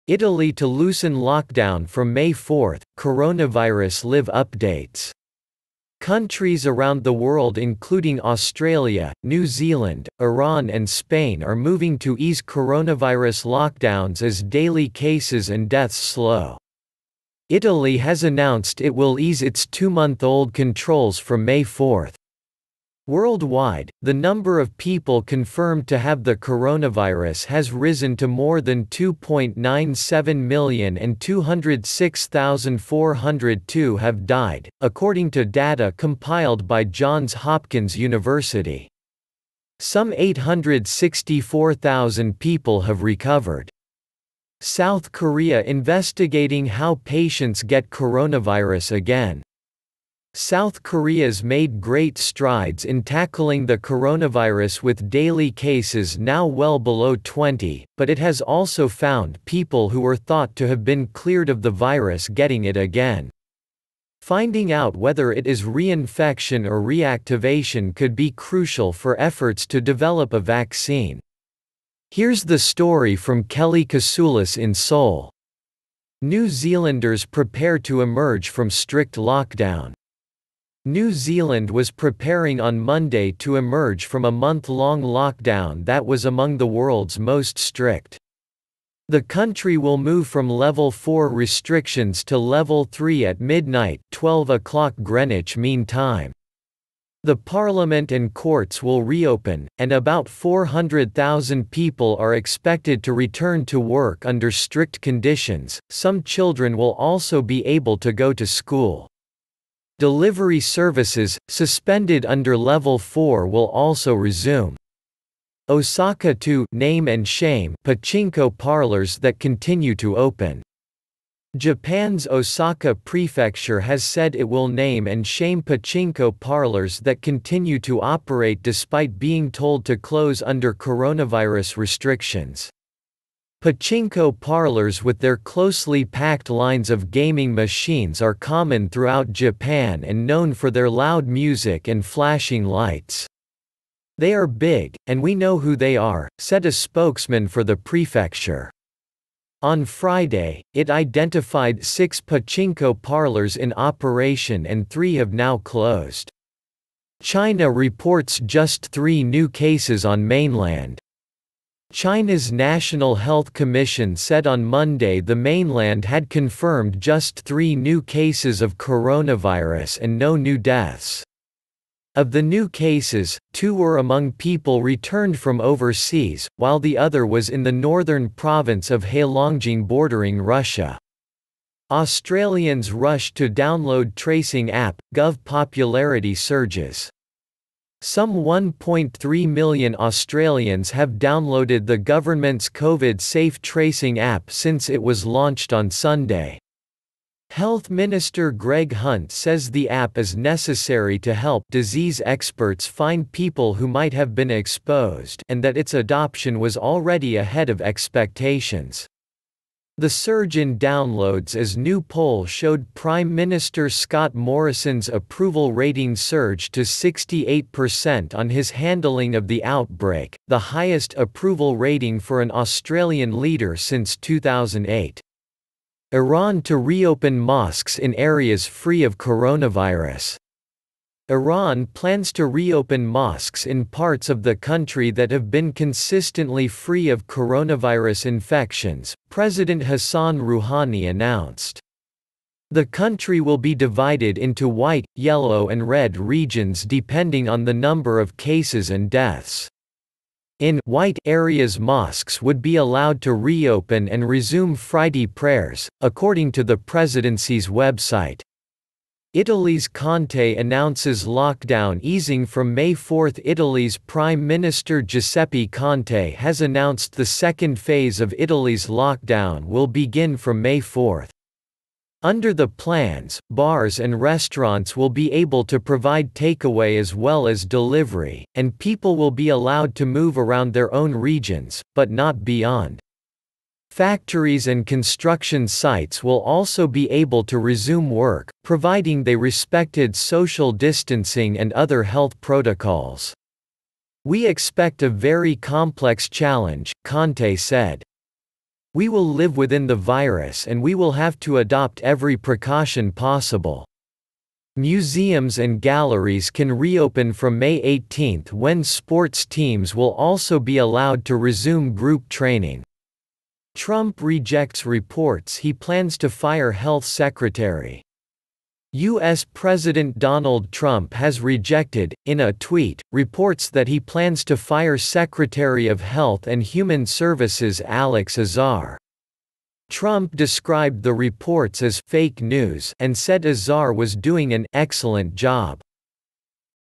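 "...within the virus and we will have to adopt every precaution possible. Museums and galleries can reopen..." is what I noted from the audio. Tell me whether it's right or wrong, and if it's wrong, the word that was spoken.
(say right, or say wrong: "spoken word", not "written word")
right.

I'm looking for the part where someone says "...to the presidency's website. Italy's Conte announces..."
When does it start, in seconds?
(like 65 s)
256 s.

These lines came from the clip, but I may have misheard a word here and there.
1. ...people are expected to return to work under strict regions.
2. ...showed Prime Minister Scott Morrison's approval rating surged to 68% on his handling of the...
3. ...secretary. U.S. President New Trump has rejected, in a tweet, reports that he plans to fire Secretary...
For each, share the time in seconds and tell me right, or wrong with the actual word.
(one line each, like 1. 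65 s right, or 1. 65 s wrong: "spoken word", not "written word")
1. 101 s wrong: "conditions", not "regions"
2. 212 s right
3. 317 s wrong: "Donald", not "New".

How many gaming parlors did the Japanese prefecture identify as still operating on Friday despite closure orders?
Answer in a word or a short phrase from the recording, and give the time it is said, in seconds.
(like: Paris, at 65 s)
6, at 151 s.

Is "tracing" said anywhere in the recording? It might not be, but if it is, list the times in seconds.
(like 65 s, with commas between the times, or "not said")
184 s, 193 s.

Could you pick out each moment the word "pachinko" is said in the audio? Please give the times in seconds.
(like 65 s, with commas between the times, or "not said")
117 s, 125 s, 133 s, 152 s.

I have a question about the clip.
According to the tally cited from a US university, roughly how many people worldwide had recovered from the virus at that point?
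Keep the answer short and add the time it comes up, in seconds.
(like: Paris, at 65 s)
864,000, at 40 s.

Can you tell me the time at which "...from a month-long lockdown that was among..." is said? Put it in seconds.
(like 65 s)
84 s.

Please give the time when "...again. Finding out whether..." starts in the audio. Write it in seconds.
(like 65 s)
62 s.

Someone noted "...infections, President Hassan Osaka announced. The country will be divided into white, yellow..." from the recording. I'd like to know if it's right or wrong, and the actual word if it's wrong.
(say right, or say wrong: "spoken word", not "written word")
wrong: "Rouhani", not "Osaka".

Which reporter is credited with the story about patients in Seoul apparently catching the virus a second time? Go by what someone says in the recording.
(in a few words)
Kelly Kasulis.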